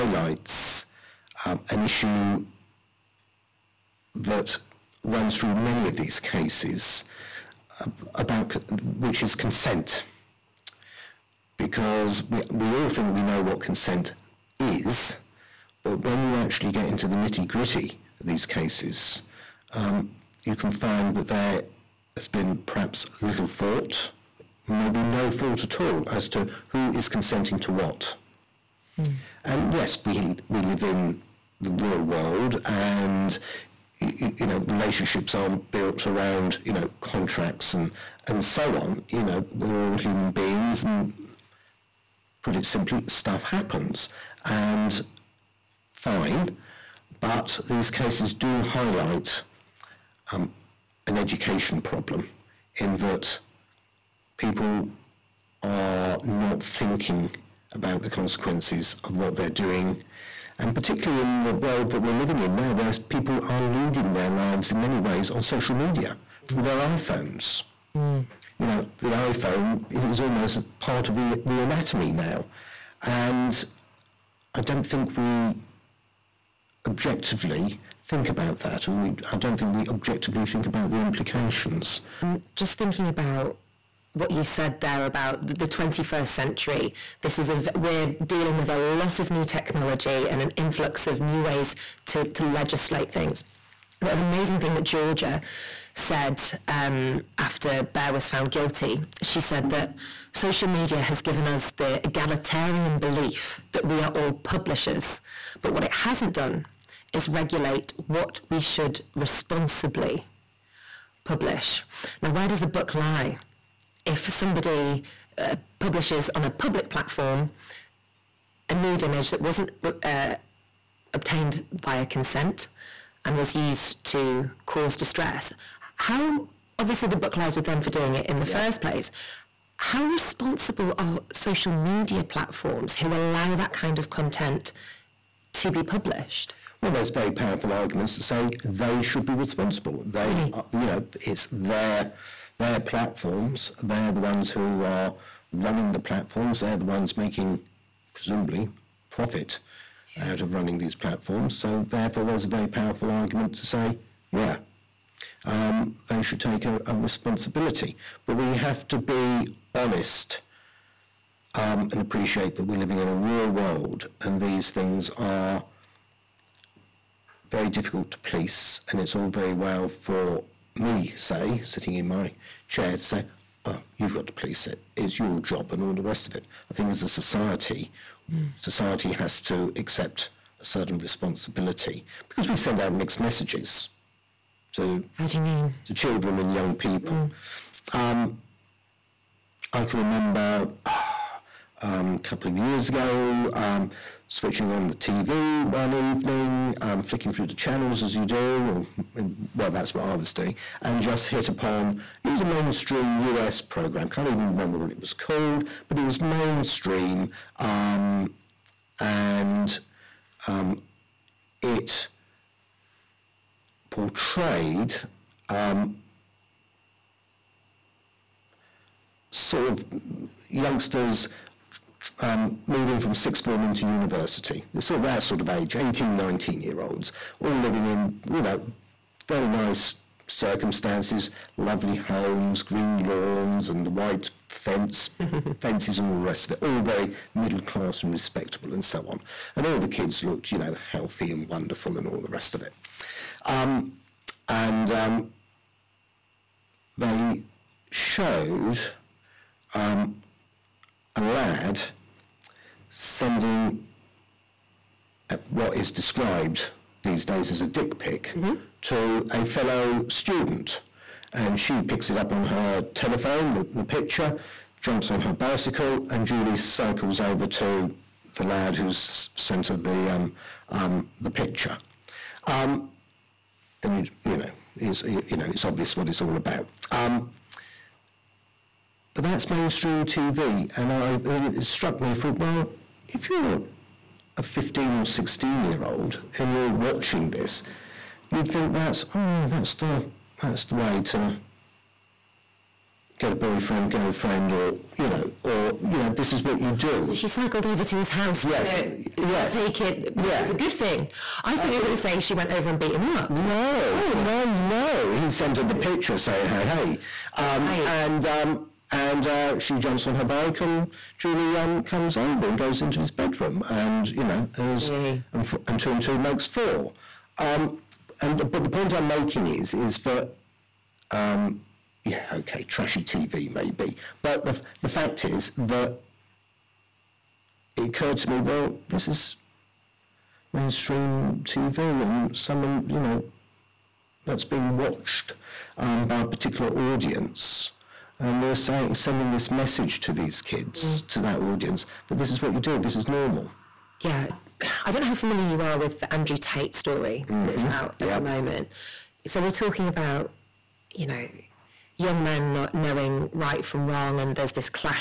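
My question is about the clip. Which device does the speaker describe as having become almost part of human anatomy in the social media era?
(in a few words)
iPhone.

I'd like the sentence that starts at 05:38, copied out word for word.
And we're saying, sending this message to these kids, mm.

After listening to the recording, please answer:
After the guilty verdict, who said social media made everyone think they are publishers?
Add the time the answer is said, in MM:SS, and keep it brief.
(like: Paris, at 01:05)
Georgia, at 01:34.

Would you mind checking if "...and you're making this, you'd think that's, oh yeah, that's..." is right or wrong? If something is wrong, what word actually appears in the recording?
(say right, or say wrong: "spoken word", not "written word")
wrong: "watching", not "making".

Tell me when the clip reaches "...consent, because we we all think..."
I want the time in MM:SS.
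00:09.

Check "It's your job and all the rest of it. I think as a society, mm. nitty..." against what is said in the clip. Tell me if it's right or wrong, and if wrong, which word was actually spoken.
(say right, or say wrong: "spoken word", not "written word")
wrong: "society", not "nitty".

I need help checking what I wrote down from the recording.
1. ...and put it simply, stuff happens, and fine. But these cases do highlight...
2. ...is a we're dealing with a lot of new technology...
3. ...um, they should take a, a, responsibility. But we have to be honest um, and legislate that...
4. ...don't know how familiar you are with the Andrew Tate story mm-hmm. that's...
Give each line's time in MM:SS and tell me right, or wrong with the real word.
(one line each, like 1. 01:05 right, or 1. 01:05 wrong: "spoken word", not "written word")
1. 00:40 right
2. 01:27 right
3. 02:35 wrong: "appreciate", not "legislate"
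4. 05:44 right.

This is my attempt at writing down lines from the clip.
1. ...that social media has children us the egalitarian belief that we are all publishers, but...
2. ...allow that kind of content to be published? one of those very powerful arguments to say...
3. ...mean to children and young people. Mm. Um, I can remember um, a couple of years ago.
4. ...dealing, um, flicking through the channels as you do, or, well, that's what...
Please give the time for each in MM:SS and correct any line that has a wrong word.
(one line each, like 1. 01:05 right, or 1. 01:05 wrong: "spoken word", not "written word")
1. 01:39 wrong: "given", not "children"
2. 02:13 right
3. 03:05 right
4. 03:15 wrong: "evening", not "dealing".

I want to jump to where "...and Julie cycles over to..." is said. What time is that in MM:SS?
04:26.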